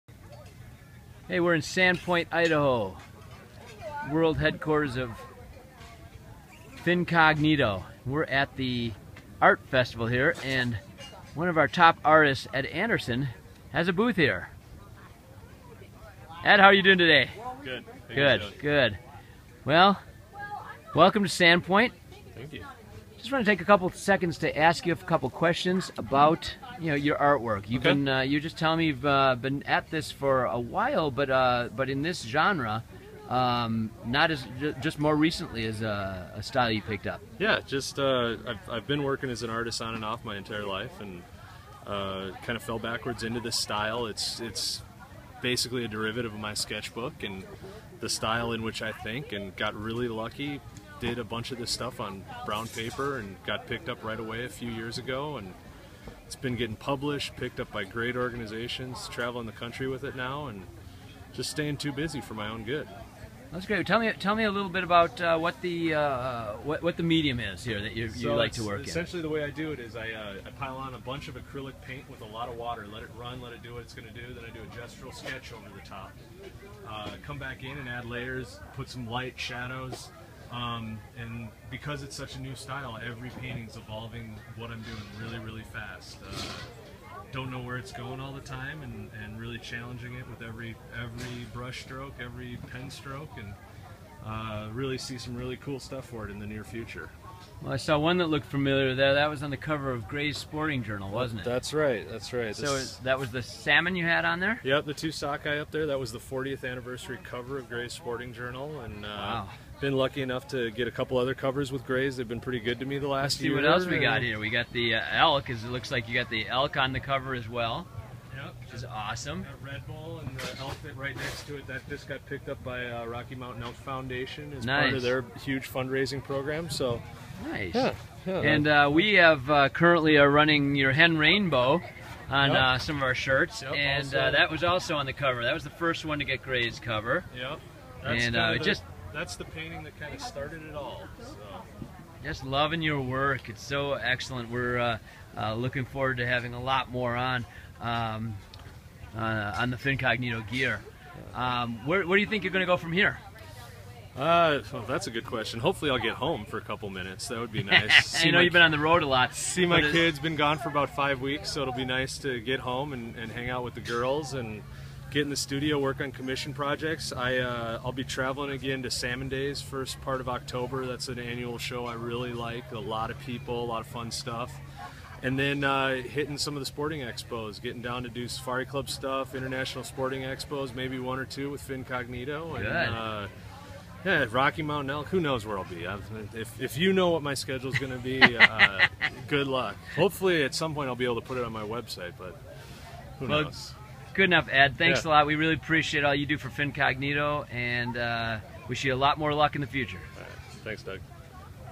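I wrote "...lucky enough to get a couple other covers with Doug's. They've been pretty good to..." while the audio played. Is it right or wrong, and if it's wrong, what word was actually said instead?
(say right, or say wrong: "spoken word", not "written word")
wrong: "Gray", not "Doug".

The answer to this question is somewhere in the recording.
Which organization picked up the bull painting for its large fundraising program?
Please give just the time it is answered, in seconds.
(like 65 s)
123 s.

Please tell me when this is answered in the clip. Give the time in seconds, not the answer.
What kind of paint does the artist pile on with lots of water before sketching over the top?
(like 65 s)
71 s.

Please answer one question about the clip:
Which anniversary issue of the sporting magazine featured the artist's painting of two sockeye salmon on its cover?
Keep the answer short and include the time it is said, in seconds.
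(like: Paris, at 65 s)
40th, at 106 s.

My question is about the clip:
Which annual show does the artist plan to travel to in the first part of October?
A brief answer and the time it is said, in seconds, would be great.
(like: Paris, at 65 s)
Salmon Days, at 168 s.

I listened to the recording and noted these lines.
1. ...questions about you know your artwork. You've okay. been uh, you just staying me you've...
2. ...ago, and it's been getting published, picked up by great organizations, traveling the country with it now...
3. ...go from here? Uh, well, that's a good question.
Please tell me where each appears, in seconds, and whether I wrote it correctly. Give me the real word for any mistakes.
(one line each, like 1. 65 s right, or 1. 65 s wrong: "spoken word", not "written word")
1. 25 s wrong: "telling", not "staying"
2. 54 s right
3. 152 s right.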